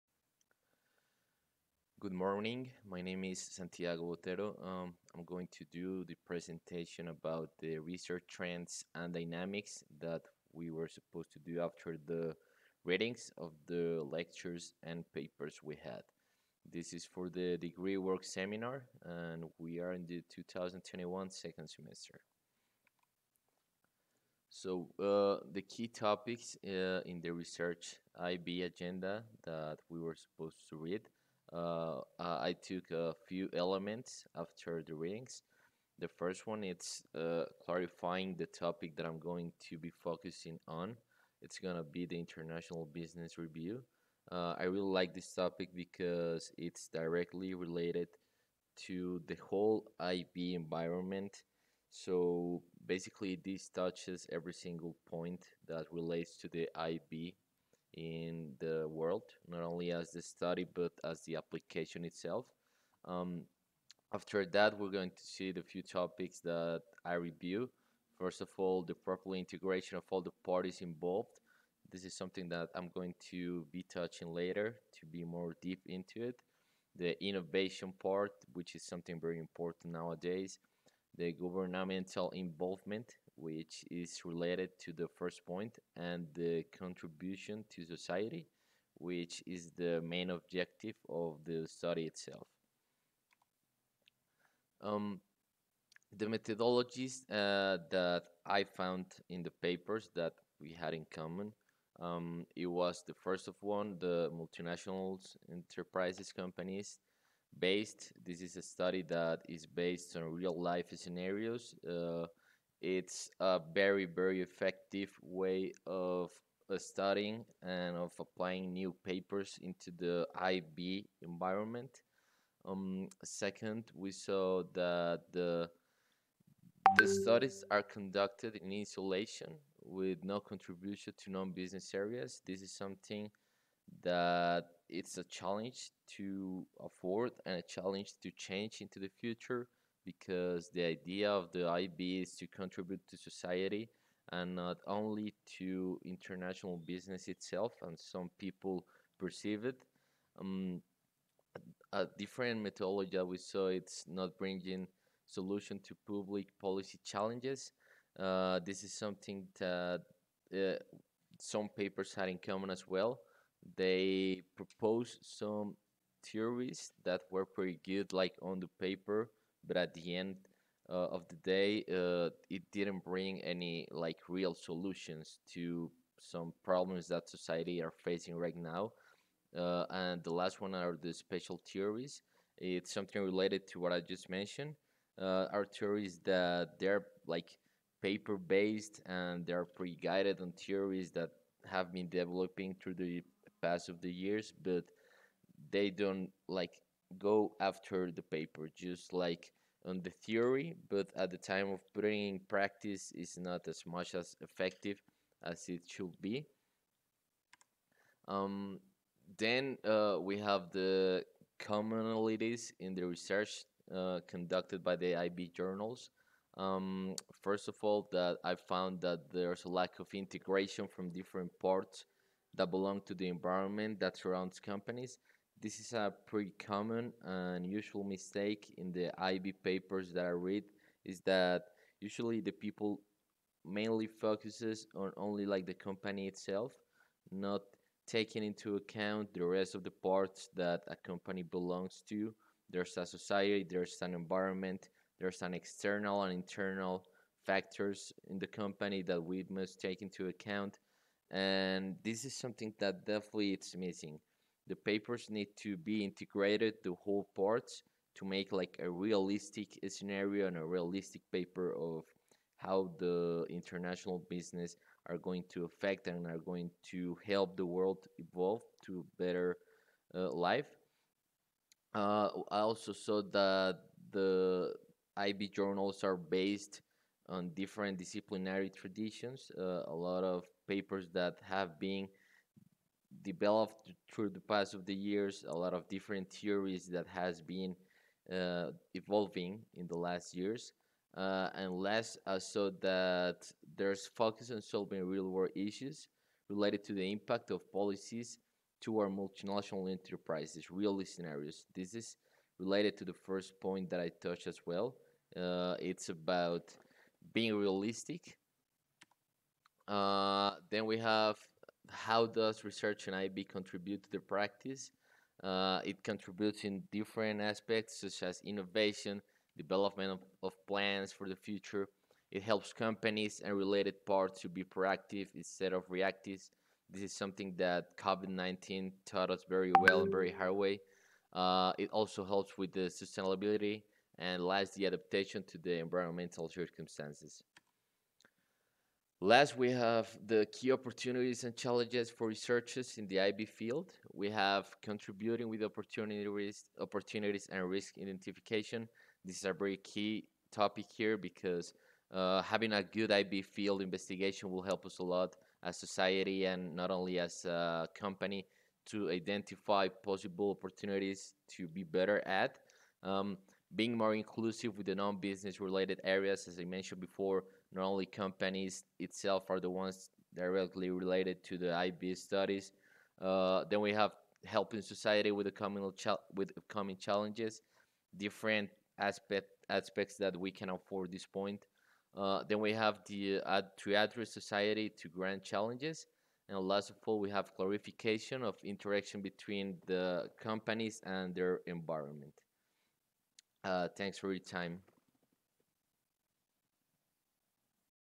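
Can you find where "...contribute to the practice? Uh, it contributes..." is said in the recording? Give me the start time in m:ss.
5:13.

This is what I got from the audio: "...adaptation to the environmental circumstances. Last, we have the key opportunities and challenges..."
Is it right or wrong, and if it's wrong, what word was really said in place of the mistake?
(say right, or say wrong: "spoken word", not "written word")
right.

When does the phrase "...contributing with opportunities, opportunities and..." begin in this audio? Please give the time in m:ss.
5:44.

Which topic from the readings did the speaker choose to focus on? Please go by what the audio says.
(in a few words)
international business review.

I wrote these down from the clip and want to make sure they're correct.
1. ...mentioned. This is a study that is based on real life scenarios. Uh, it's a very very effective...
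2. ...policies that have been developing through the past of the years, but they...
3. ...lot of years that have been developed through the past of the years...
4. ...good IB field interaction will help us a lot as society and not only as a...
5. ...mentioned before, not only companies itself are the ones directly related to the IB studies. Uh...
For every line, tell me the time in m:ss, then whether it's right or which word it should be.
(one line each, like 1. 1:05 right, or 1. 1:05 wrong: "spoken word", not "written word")
1. 1:47 wrong: "based", not "mentioned"
2. 3:10 wrong: "theories", not "policies"
3. 4:40 wrong: "papers", not "years"
4. 5:52 wrong: "investigation", not "interaction"
5. 6:06 right.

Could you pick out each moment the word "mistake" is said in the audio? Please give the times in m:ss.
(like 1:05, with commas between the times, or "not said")
3:48.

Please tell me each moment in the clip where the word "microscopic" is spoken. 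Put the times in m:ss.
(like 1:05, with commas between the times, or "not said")
not said.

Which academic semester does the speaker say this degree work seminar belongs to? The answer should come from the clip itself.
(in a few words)
2021 second semester.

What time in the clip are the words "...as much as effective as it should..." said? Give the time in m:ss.
3:23.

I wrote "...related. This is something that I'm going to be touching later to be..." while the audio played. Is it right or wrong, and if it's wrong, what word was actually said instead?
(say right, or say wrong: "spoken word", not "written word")
wrong: "involved", not "related".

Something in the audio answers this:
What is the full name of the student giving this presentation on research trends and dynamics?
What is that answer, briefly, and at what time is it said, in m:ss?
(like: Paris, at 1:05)
Santiago Botero, at 0:03.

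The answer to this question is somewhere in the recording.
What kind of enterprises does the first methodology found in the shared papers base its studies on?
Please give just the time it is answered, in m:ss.
1:44.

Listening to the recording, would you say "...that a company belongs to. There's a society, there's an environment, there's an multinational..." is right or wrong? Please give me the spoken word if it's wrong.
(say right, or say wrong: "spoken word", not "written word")
wrong: "external", not "multinational".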